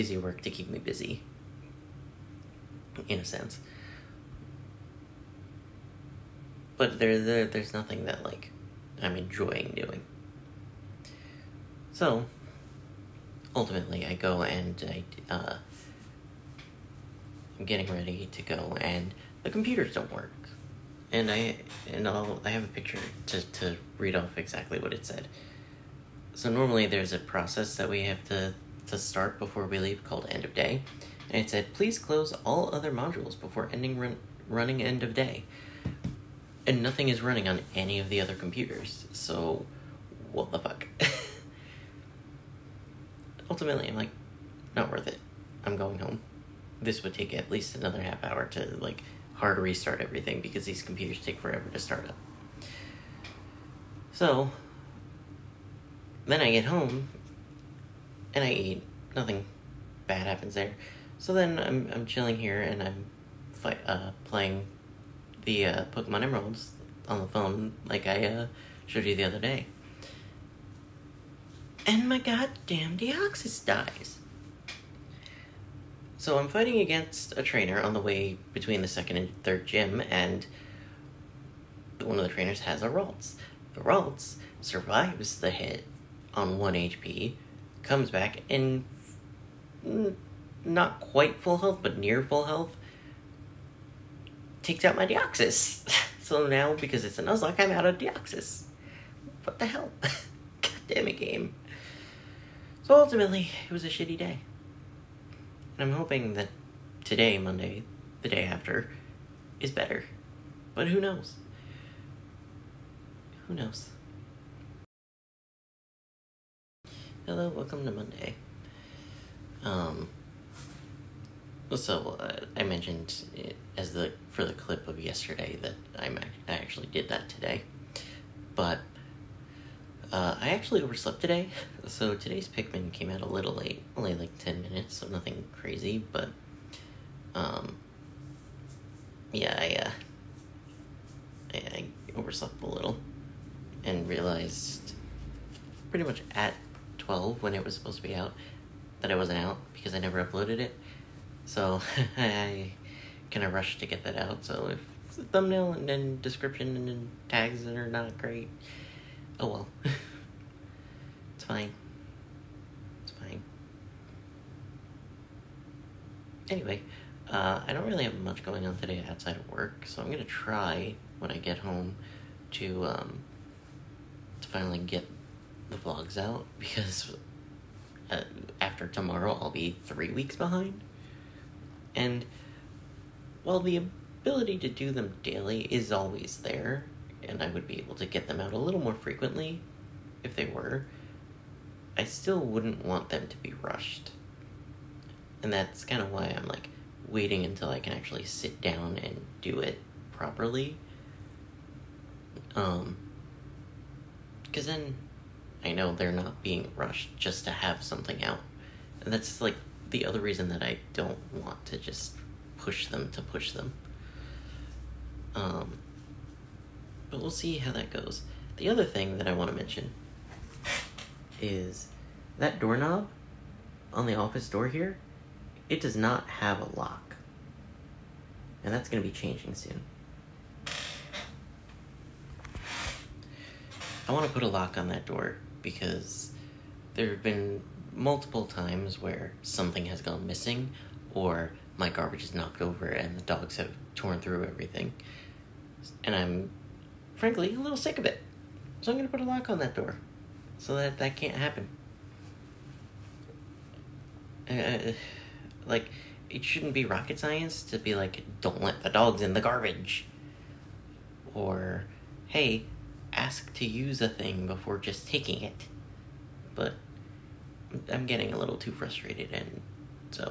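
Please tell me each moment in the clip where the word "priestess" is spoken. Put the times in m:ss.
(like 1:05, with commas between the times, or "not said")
not said.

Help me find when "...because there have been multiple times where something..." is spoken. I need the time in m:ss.
3:55.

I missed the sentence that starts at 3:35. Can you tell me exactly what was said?
Um, but we'll see how that goes.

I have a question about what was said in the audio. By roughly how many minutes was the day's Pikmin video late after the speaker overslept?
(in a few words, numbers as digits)
10 minutes.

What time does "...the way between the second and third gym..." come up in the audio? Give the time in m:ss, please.
1:17.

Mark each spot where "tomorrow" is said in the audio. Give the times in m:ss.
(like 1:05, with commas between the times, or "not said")
2:58.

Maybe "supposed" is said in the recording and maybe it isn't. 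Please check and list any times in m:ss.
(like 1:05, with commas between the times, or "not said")
2:27.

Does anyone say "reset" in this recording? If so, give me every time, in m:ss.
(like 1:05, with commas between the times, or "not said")
not said.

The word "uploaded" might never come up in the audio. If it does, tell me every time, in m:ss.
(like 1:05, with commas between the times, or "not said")
2:30.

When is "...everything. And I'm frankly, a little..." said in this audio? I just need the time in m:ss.
4:04.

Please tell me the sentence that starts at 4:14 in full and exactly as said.
Uh, uh, like, it shouldn't be rocket science to be like, don't let the dogs in the garbage.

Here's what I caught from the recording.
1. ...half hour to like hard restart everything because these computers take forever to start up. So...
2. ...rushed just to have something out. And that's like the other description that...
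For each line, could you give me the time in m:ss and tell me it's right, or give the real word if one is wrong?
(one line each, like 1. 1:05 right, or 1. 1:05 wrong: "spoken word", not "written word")
1. 0:48 right
2. 3:26 wrong: "reason", not "description".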